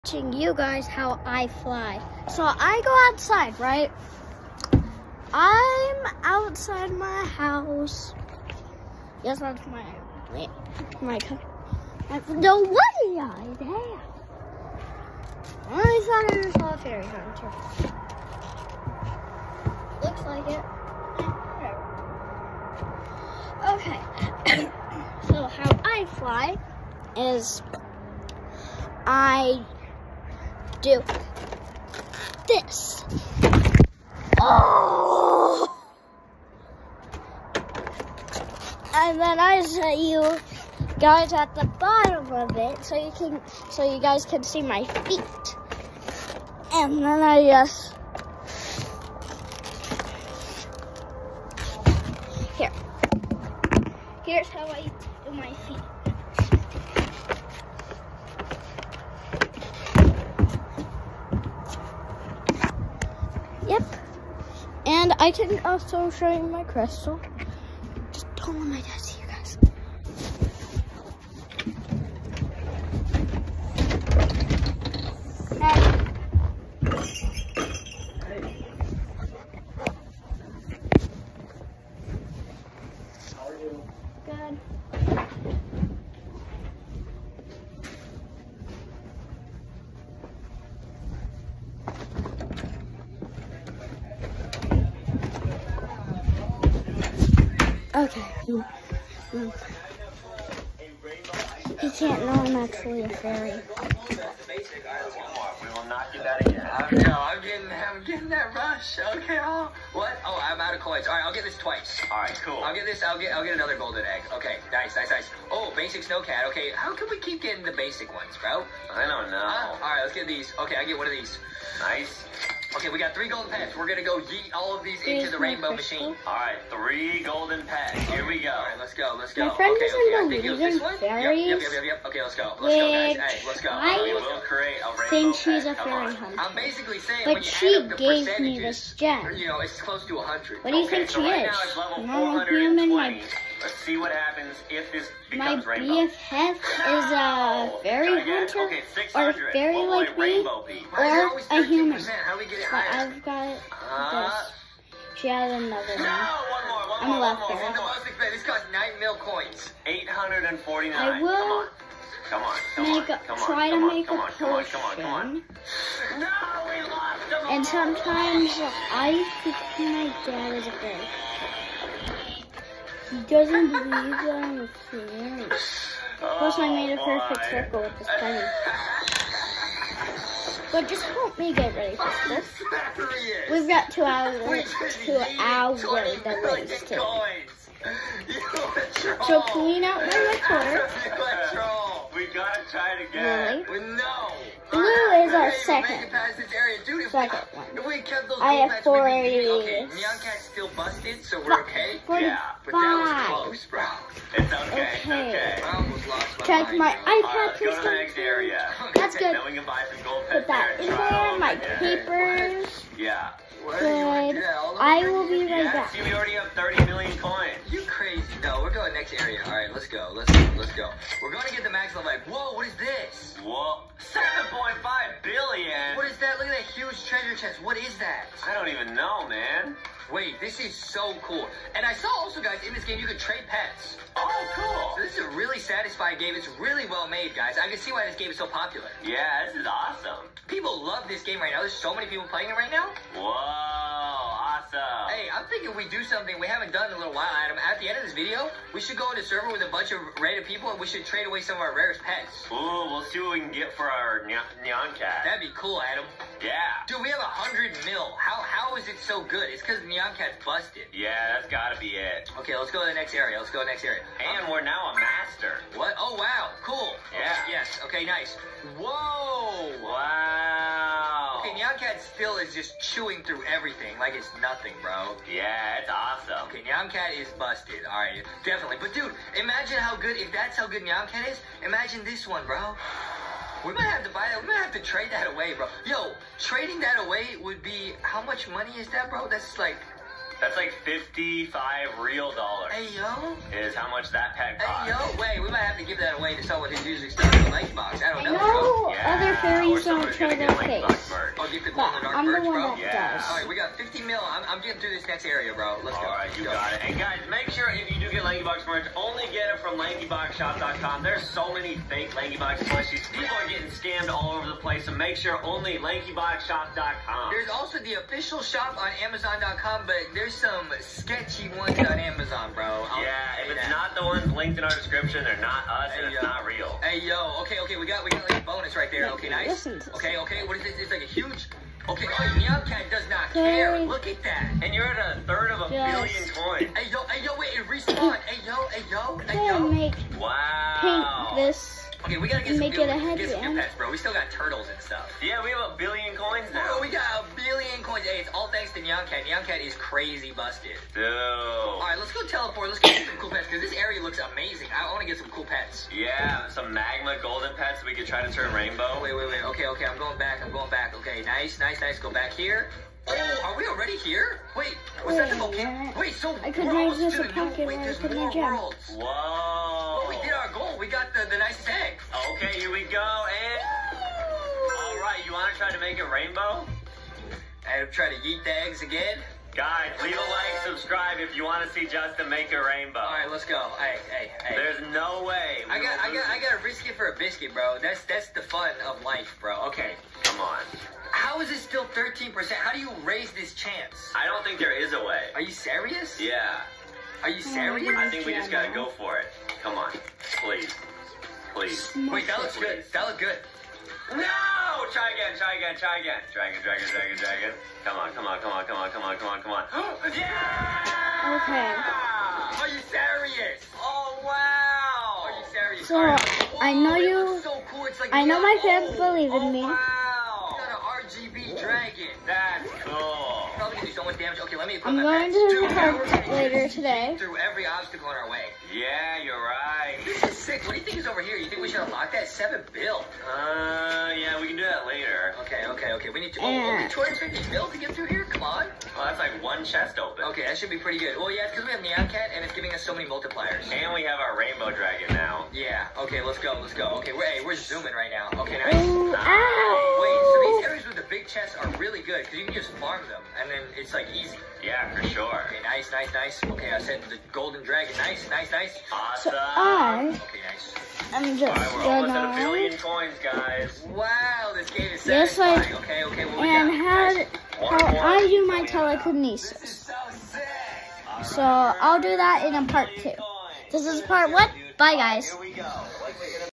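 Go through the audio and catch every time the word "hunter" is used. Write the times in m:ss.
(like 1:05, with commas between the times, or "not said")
0:17, 2:16, 2:28.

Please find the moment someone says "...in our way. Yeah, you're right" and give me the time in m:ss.
7:08.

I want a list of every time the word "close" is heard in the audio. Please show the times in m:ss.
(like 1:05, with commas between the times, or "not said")
2:19, 3:23.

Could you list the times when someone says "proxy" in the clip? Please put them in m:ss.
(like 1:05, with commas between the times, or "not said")
not said.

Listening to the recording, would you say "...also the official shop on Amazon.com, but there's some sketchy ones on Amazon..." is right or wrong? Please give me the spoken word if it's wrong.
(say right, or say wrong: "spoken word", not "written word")
right.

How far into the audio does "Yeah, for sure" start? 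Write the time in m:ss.
7:34.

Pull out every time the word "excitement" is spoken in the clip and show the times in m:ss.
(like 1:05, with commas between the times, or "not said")
not said.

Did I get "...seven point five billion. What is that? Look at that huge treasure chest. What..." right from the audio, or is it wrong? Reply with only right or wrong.
right.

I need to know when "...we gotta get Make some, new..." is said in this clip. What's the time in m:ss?
5:42.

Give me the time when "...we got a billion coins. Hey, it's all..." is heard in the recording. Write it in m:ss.
5:46.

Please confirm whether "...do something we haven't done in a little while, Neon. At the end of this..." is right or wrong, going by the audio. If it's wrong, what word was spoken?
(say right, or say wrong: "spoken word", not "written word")
wrong: "Adam", not "Neon".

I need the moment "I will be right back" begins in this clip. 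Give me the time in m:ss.
3:34.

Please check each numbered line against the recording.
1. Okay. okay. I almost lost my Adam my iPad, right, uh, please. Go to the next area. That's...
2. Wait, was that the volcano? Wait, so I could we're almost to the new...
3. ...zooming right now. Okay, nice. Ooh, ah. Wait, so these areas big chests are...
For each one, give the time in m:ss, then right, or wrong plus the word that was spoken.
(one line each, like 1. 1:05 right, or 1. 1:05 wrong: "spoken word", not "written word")
1. 3:24 wrong: "Check", not "Adam"
2. 6:04 right
3. 7:27 right.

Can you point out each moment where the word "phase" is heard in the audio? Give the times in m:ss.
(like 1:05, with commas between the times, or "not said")
not said.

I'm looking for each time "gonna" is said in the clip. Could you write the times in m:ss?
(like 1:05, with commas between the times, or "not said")
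2:03, 5:00, 7:03, 7:41.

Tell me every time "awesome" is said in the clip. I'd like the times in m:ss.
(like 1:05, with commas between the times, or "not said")
3:59, 4:04, 4:35, 7:38.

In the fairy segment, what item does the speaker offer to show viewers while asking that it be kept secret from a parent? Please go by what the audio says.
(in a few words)
crystal.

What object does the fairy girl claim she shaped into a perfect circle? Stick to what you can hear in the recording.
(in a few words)
penny.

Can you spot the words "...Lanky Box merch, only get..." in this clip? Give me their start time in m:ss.
5:08.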